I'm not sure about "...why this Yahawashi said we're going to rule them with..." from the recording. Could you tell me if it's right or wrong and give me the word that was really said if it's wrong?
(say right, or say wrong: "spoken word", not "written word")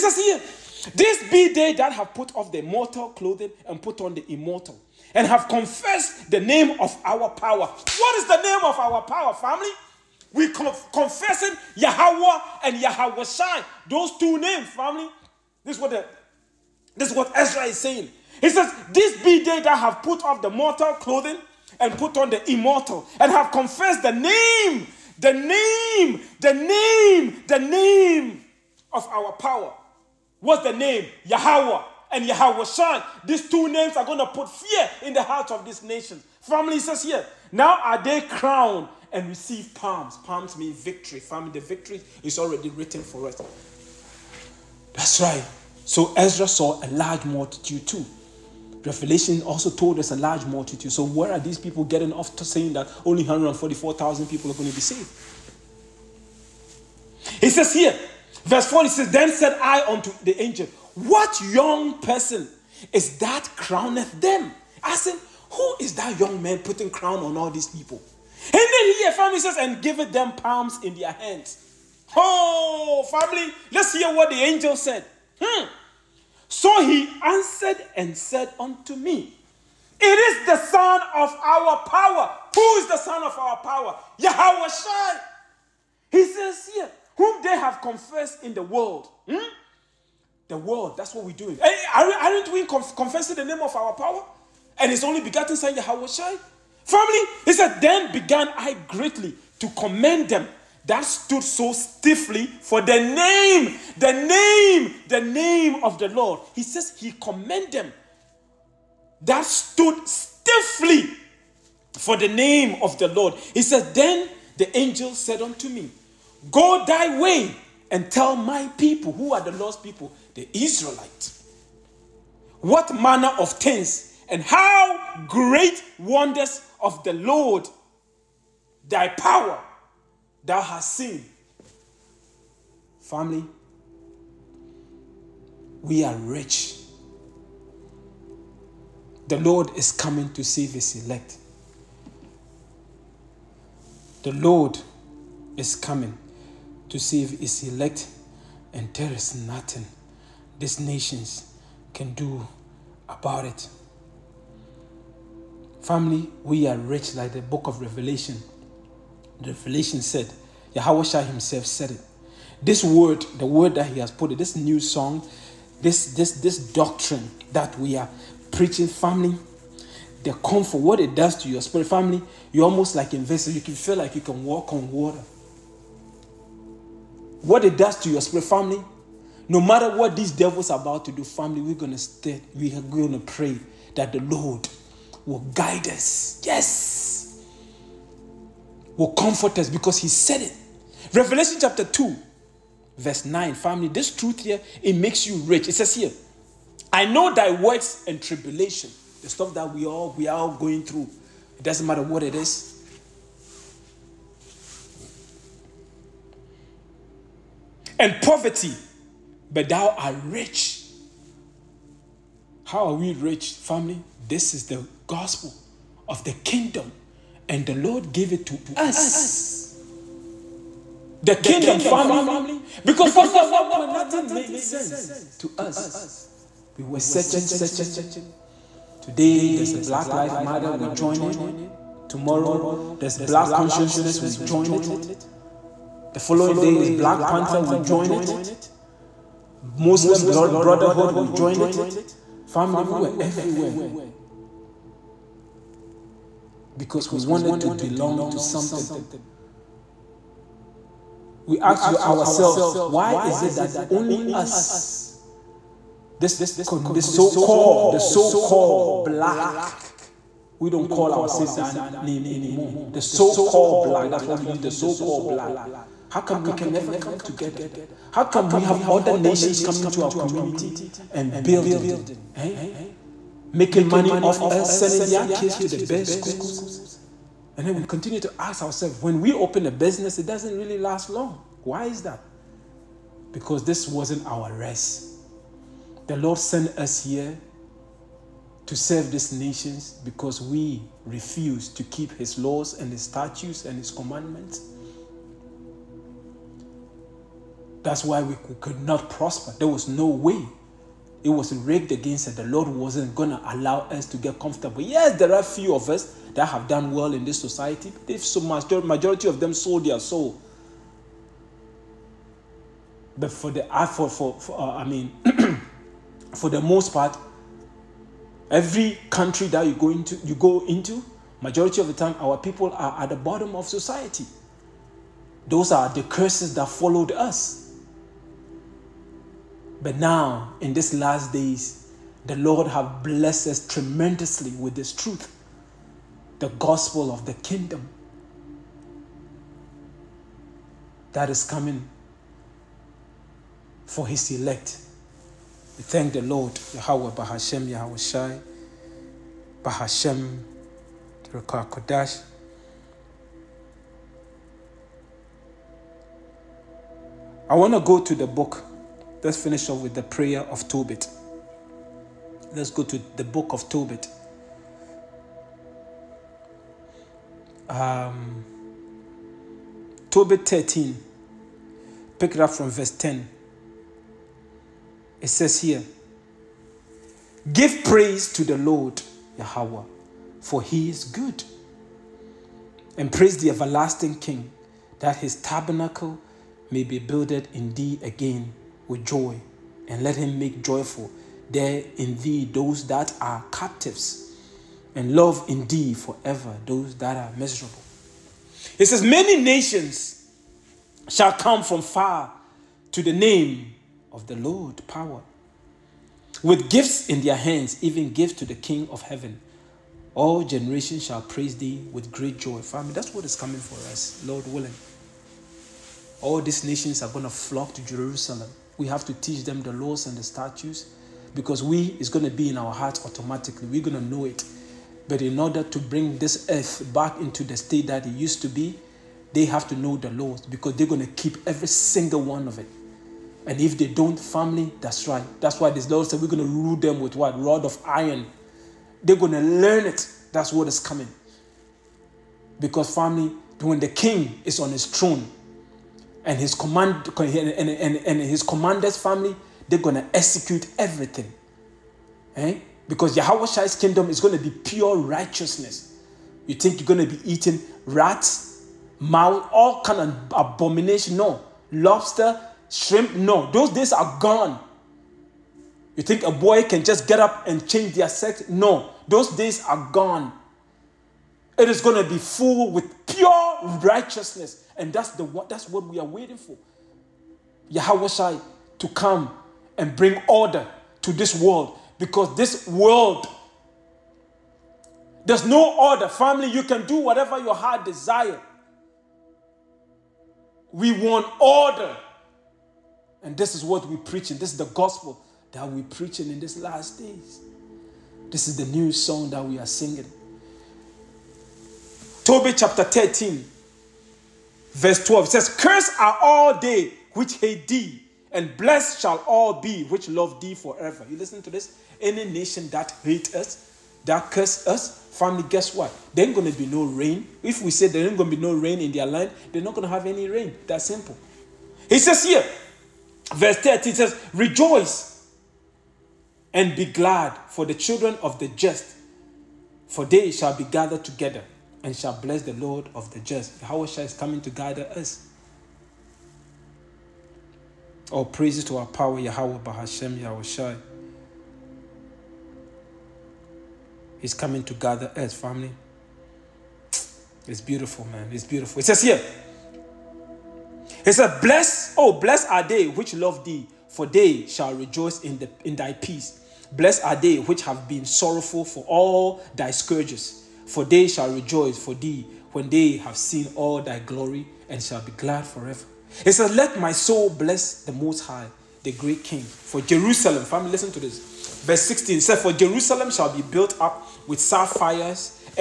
wrong: "Lord", not "Yahawashi".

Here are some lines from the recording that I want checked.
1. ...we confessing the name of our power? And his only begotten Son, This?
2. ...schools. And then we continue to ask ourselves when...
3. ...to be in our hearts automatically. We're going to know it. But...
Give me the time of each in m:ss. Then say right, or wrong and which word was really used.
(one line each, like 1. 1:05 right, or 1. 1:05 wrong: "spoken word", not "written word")
1. 1:32 wrong: "Yahawashi", not "This"
2. 4:36 right
3. 7:02 right.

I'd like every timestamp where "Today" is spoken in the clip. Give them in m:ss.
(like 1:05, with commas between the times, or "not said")
3:49.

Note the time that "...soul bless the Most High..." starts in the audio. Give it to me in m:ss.
9:26.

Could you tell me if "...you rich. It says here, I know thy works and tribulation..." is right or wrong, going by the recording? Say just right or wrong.
right.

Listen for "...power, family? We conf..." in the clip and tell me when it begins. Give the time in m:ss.
0:09.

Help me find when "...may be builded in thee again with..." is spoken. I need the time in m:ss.
6:26.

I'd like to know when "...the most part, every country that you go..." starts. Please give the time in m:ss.
5:16.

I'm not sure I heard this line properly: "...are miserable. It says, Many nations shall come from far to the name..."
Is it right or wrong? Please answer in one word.
right.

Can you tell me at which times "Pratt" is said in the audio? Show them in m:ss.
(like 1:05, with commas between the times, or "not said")
not said.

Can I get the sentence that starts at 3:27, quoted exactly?
And poverty, but thou art rich.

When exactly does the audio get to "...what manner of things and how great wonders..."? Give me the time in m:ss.
2:02.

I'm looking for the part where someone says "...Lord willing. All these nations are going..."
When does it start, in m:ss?
6:54.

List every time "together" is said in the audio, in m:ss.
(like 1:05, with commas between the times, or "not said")
4:27, 8:51.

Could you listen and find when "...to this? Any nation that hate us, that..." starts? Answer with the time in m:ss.
8:31.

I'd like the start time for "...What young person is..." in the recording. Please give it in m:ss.
1:00.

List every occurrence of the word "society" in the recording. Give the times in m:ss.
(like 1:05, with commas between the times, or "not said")
5:07, 5:23.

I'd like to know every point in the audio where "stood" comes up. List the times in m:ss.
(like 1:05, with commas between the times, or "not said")
1:41, 1:49.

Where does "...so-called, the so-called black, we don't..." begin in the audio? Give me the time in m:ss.
4:17.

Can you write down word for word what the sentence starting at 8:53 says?
Yahusha is coming to gather us.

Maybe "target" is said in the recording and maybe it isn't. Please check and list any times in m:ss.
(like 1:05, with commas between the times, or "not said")
not said.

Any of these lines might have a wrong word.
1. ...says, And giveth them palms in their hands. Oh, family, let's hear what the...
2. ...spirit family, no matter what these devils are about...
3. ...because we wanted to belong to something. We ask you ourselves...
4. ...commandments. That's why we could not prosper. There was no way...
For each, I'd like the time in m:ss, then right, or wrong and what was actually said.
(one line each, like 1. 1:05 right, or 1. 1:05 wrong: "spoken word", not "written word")
1. 1:09 right
2. 2:58 right
3. 4:06 right
4. 4:53 right.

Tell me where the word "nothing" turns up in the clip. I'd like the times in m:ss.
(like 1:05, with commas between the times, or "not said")
2:29, 3:43.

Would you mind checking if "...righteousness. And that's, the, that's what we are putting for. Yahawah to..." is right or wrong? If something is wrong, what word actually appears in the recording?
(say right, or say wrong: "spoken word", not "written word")
wrong: "waiting", not "putting".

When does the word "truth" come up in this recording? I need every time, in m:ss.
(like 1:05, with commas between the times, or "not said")
3:14, 5:34.